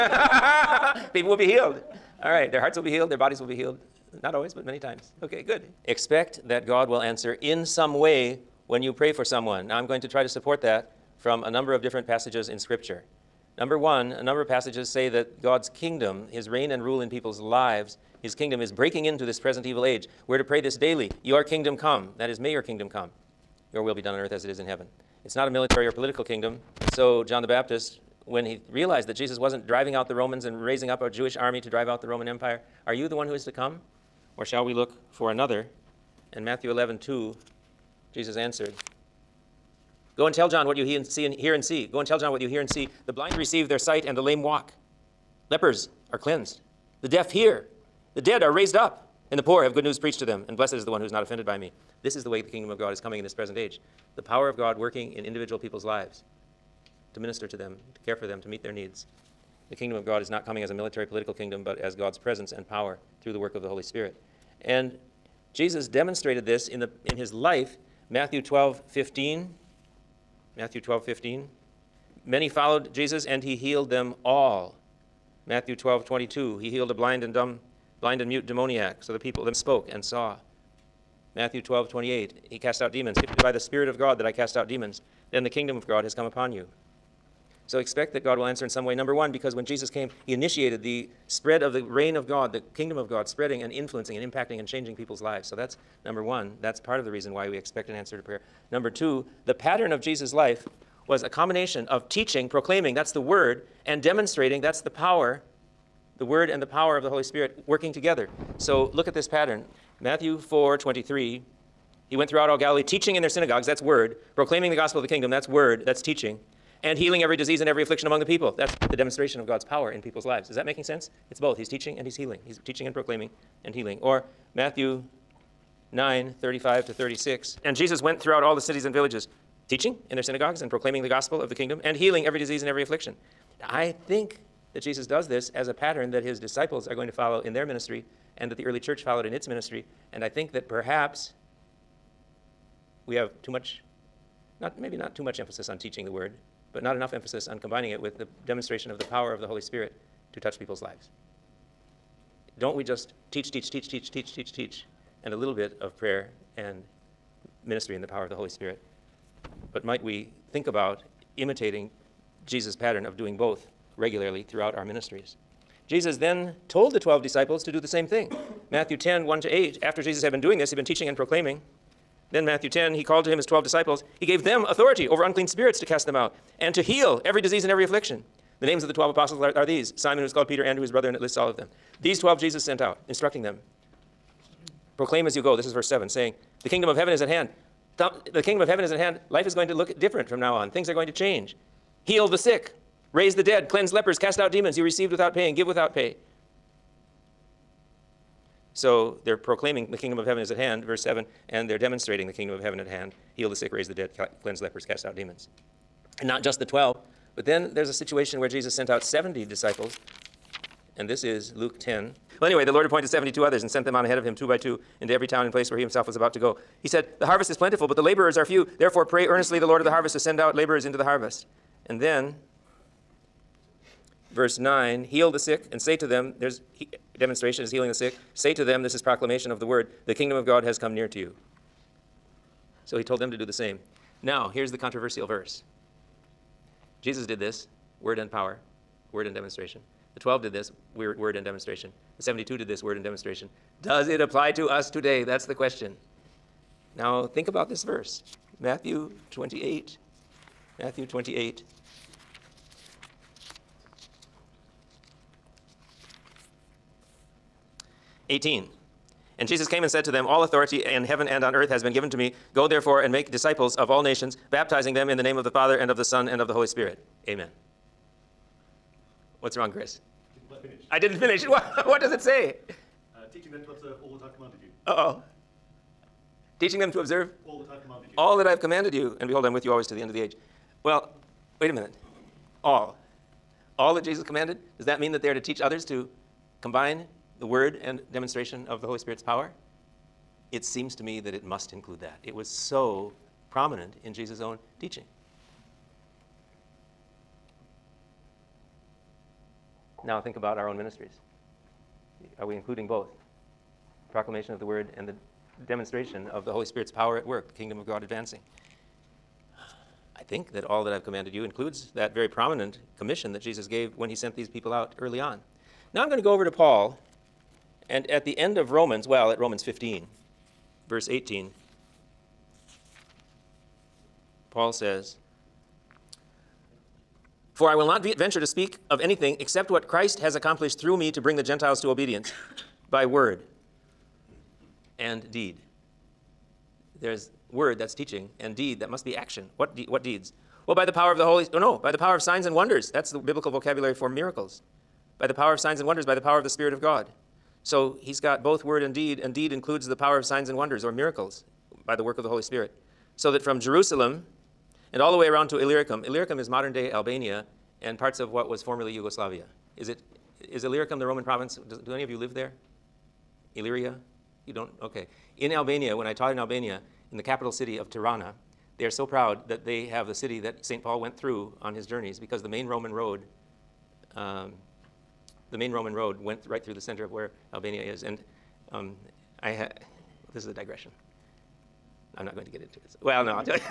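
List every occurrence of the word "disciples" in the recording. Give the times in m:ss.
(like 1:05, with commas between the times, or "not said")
2:16, 2:47, 2:53, 3:29, 4:23.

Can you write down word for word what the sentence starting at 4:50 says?
It seems to me that it must include that.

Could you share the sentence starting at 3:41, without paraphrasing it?
And then verse 9 heal the sick and say to them, there's he, demonstration is healing the sick.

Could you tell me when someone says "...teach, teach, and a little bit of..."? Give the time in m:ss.
2:34.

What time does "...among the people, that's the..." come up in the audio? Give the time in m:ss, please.
1:58.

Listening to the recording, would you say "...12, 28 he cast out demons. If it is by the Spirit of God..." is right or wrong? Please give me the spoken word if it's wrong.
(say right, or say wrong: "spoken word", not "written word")
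right.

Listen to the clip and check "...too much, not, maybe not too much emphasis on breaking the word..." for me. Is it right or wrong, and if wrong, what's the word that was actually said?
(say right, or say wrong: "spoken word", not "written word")
wrong: "teaching", not "breaking".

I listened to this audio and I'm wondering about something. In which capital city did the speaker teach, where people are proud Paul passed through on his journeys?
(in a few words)
Tirana.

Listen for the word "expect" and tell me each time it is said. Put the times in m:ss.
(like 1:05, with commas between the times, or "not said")
0:05, 1:27, 1:37.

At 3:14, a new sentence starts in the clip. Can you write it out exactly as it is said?
You received without paying, give without pay.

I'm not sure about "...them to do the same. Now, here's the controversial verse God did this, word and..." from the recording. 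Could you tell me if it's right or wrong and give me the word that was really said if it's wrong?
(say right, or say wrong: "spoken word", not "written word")
wrong: "Jesus", not "God".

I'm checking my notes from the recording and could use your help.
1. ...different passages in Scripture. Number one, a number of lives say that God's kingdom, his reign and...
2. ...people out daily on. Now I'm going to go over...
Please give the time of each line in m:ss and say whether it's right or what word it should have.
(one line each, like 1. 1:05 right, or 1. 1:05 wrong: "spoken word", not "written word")
1. 0:11 wrong: "passages", not "lives"
2. 5:14 wrong: "early", not "daily".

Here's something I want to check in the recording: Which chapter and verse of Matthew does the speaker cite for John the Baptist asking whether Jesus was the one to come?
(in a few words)
Matthew 11:2.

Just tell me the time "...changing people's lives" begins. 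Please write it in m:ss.
1:34.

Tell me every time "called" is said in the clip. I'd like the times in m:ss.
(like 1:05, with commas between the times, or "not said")
2:53, 3:00.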